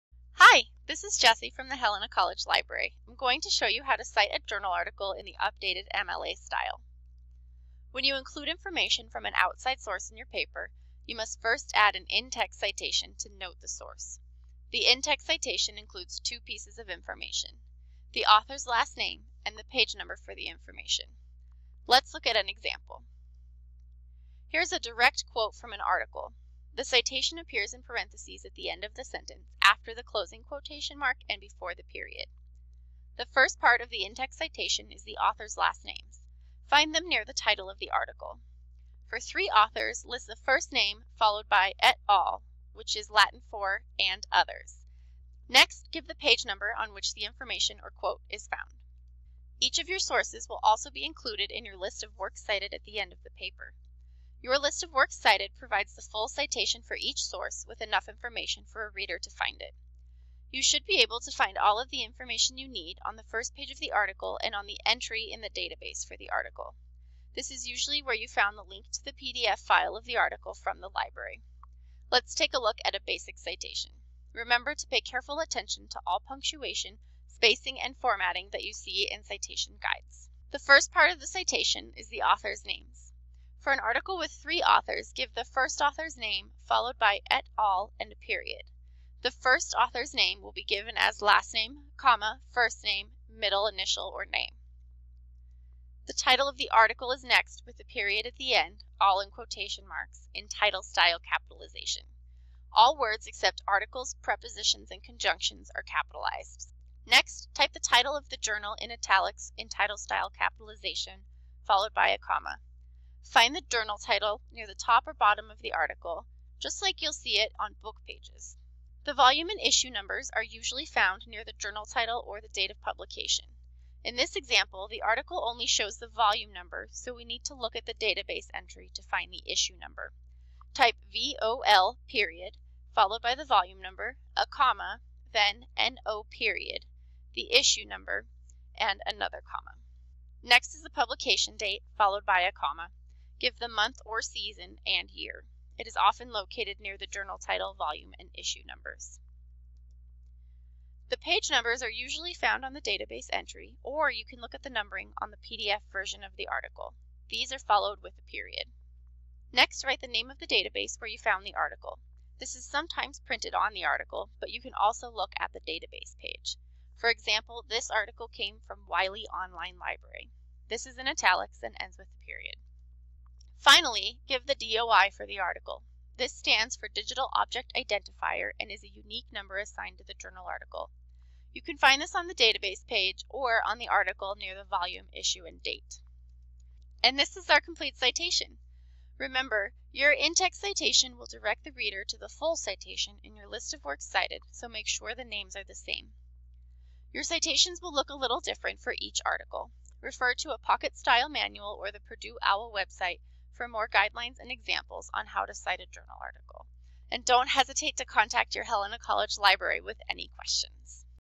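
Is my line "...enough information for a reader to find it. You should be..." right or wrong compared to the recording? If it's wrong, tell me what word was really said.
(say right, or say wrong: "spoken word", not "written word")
right.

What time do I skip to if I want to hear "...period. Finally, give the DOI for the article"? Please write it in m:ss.
2:52.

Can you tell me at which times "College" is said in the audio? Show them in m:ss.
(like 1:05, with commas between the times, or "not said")
0:02, 3:28.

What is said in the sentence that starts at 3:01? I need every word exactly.
You can find this on the database page or on the article near the volume, issue, and date.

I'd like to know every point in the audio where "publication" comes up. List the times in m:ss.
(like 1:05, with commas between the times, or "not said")
2:02, 2:20.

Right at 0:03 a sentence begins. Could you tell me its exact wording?
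I'm going to show you how to cite a journal article in the updated MLA style.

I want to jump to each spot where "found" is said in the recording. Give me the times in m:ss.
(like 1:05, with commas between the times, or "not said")
0:48, 1:08, 2:00, 2:32, 2:41.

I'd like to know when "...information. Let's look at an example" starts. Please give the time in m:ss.
0:20.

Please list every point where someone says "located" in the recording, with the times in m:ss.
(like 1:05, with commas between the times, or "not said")
2:26.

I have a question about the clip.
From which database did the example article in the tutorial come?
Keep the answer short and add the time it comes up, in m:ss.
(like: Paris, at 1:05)
Wiley Online Library, at 2:48.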